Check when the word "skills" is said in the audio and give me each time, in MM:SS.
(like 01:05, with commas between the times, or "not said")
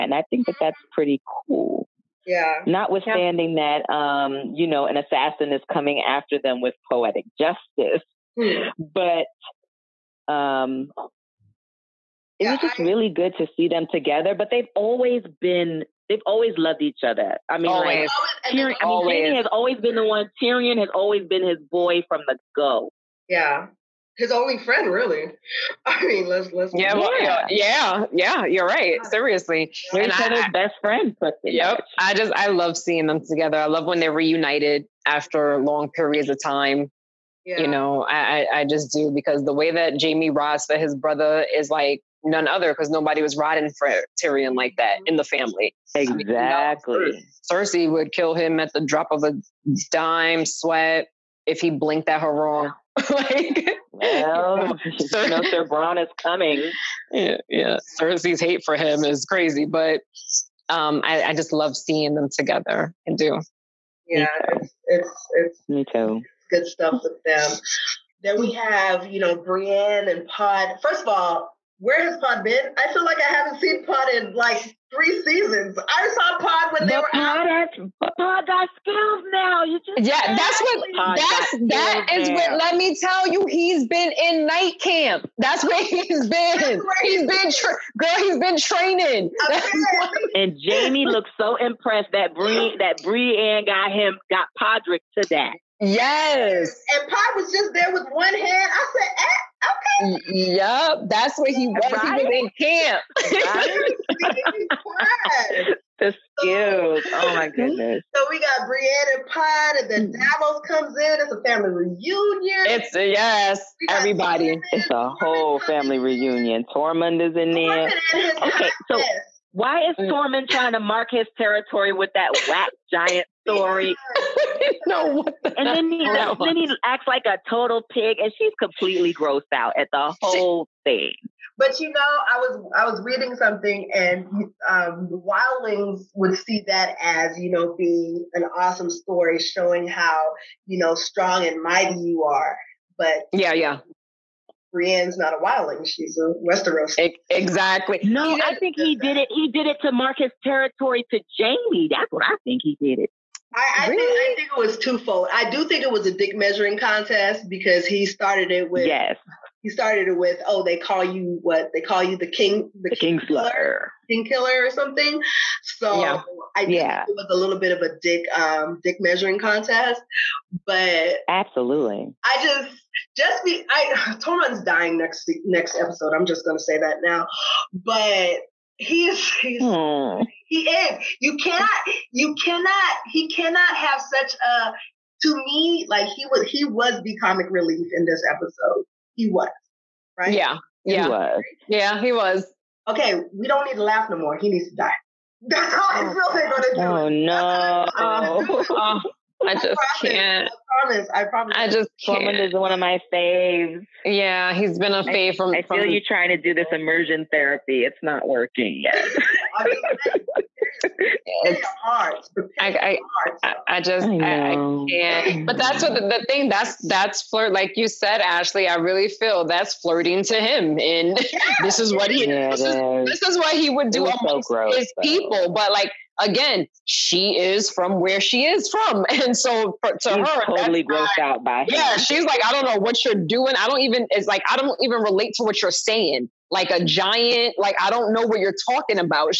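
01:18, 01:46.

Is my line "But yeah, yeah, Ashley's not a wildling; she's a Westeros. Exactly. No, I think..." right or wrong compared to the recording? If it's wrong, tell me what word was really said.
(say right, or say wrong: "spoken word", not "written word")
wrong: "Brienne", not "Ashley".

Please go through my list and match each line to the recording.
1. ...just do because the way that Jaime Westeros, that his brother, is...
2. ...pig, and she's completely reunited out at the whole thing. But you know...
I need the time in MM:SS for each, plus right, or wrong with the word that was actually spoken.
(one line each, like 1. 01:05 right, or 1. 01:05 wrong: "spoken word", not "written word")
1. 00:38 wrong: "Ross", not "Westeros"
2. 02:07 wrong: "grossed", not "reunited".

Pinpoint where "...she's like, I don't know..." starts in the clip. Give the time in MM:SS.
03:51.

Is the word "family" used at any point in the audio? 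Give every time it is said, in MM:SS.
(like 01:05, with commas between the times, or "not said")
00:45, 01:51, 01:55.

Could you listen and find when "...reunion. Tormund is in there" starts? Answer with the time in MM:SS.
01:55.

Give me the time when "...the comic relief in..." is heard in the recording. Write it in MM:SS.
03:07.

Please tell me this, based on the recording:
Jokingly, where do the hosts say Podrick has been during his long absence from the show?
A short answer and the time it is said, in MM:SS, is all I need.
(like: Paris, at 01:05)
Night camp, at 01:24.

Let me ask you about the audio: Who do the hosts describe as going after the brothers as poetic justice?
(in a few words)
an assassin.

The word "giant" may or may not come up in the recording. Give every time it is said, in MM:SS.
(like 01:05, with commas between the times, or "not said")
02:02, 03:56.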